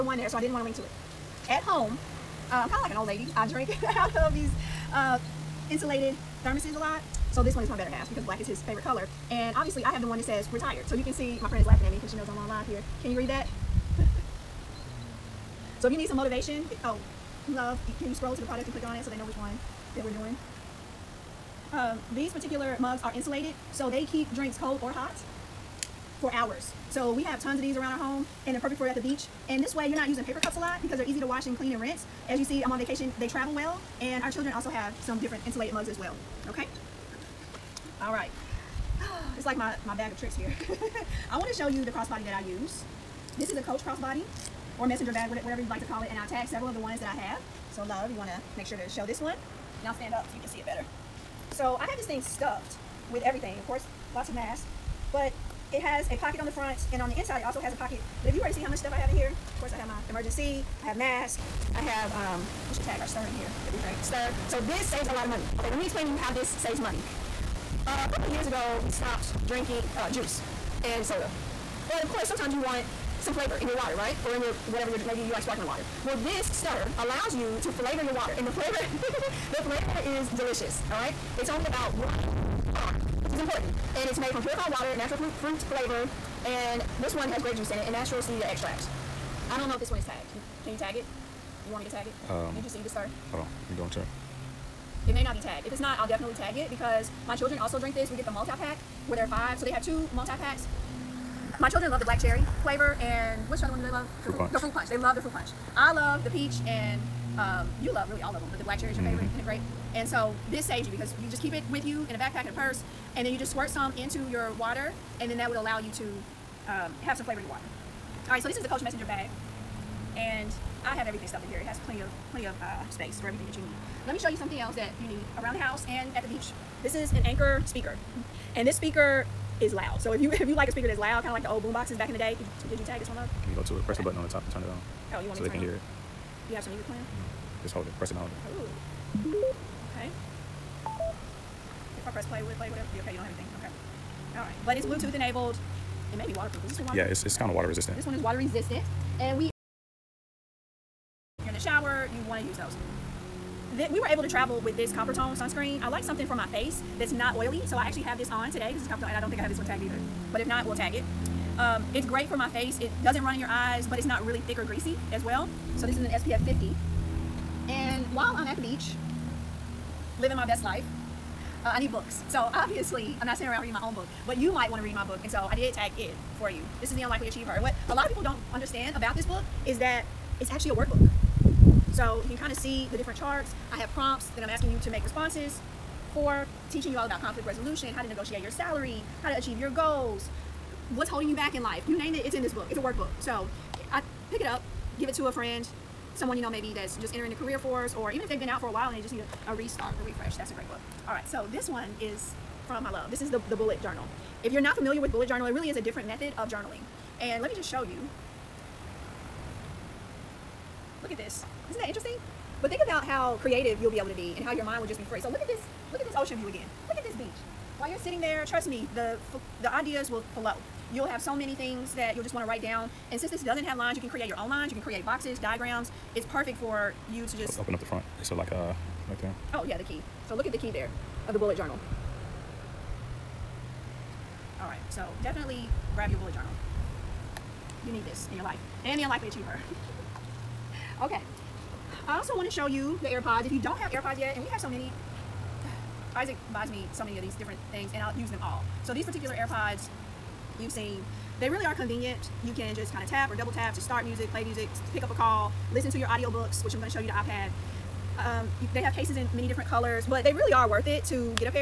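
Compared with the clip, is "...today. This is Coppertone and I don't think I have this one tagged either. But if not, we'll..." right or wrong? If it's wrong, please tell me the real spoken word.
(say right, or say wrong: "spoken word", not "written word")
right.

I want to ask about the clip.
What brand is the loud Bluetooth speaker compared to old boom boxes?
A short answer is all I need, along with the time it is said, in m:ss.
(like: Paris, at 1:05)
Anker, at 2:07.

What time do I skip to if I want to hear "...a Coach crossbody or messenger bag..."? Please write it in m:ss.
0:43.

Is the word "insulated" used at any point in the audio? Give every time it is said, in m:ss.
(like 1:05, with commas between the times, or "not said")
0:05, 0:23, 0:35.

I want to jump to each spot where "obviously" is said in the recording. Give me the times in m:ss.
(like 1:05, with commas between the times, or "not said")
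0:09, 2:52.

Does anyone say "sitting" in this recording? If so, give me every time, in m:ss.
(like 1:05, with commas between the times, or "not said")
2:53, 3:37.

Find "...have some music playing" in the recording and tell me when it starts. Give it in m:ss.
2:16.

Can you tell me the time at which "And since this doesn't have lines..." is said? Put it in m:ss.
3:43.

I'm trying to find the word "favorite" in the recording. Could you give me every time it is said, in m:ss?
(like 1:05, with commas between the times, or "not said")
0:08, 1:49.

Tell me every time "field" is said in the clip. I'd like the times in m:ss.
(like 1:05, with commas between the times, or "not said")
not said.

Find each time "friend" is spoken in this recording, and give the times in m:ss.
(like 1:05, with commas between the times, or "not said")
0:11, 3:15.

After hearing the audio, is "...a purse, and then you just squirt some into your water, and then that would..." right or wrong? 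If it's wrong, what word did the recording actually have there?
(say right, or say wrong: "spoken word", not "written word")
right.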